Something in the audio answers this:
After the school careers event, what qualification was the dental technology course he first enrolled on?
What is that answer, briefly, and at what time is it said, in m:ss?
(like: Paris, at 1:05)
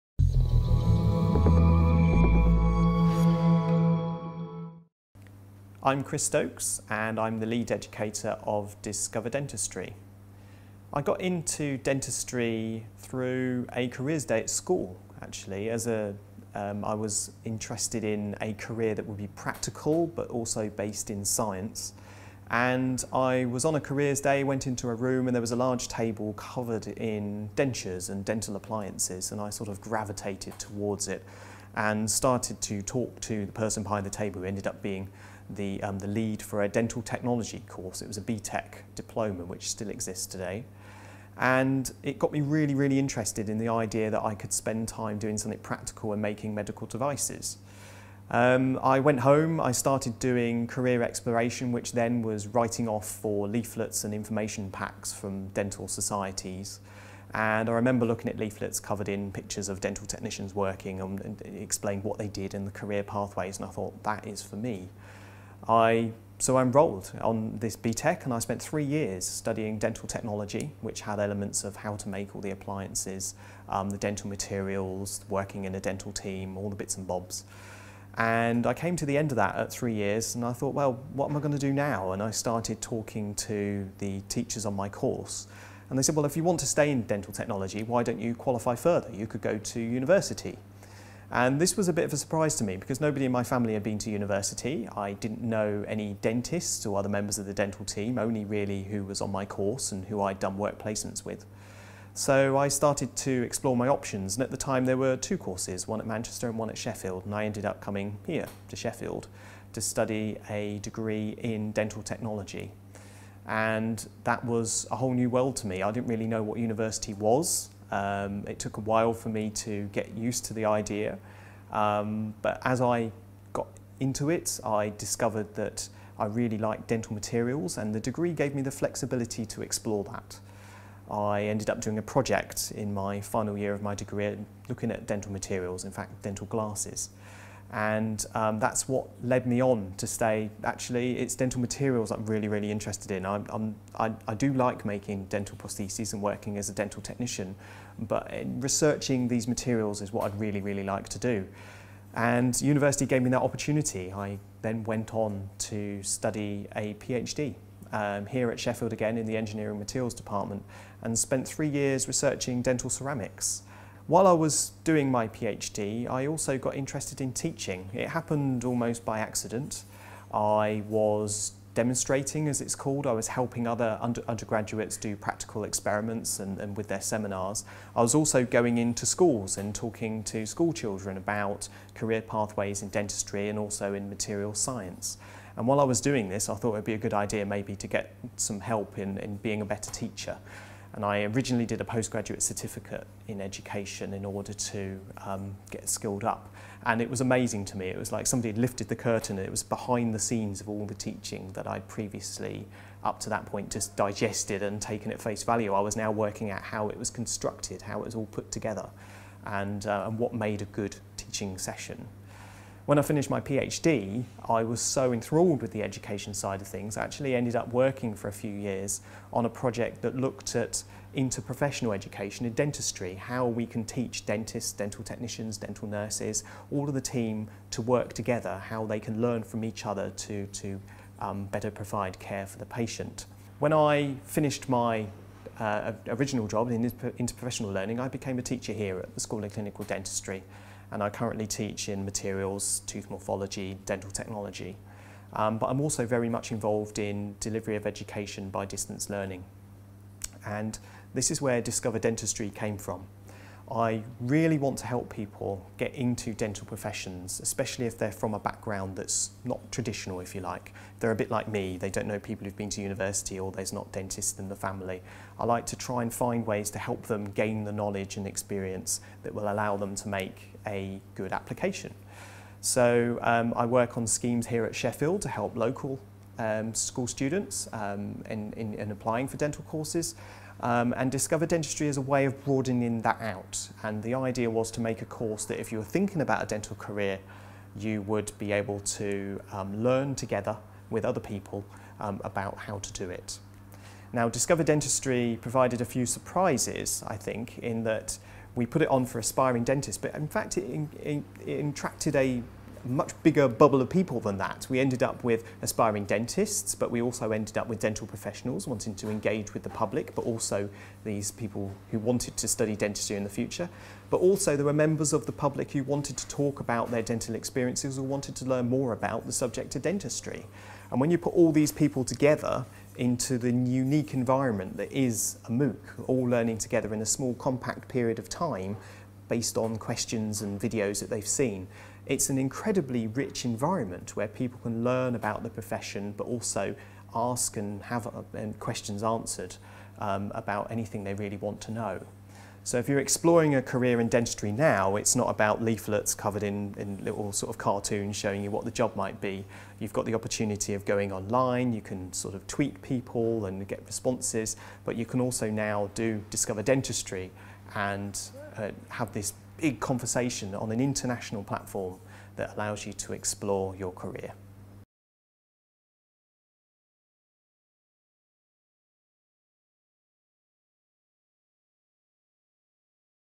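BTEC diploma, at 0:38.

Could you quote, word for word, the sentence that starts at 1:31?
And this was a bit of a surprise to me because nobody in my family had been to university.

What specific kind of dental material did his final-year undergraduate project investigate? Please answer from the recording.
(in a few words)
dental glasses.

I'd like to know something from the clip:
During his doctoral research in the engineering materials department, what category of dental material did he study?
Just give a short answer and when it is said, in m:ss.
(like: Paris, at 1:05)
dental ceramics, at 2:42.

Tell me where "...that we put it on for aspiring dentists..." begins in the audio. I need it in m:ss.
4:57.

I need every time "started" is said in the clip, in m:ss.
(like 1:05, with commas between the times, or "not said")
0:32, 0:49, 1:22, 1:42.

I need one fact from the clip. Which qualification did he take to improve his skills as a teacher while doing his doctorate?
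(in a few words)
postgraduate certificate in education.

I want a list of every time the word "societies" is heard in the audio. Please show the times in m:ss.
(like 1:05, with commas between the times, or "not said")
0:55.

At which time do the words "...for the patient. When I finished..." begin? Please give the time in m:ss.
3:52.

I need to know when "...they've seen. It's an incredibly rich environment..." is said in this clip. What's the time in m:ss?
5:31.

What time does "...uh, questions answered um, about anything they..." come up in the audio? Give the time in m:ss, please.
5:38.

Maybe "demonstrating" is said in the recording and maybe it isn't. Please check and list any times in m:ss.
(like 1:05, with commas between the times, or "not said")
2:51.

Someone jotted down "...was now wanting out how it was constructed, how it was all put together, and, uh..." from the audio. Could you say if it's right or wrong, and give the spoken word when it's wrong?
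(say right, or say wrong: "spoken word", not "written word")
wrong: "working", not "wanting".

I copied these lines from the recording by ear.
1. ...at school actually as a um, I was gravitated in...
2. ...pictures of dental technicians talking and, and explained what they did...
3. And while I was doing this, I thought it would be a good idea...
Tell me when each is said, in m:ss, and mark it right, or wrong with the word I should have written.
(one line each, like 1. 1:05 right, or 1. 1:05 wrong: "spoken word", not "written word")
1. 0:14 wrong: "interested", not "gravitated"
2. 0:59 wrong: "working", not "talking"
3. 3:05 right.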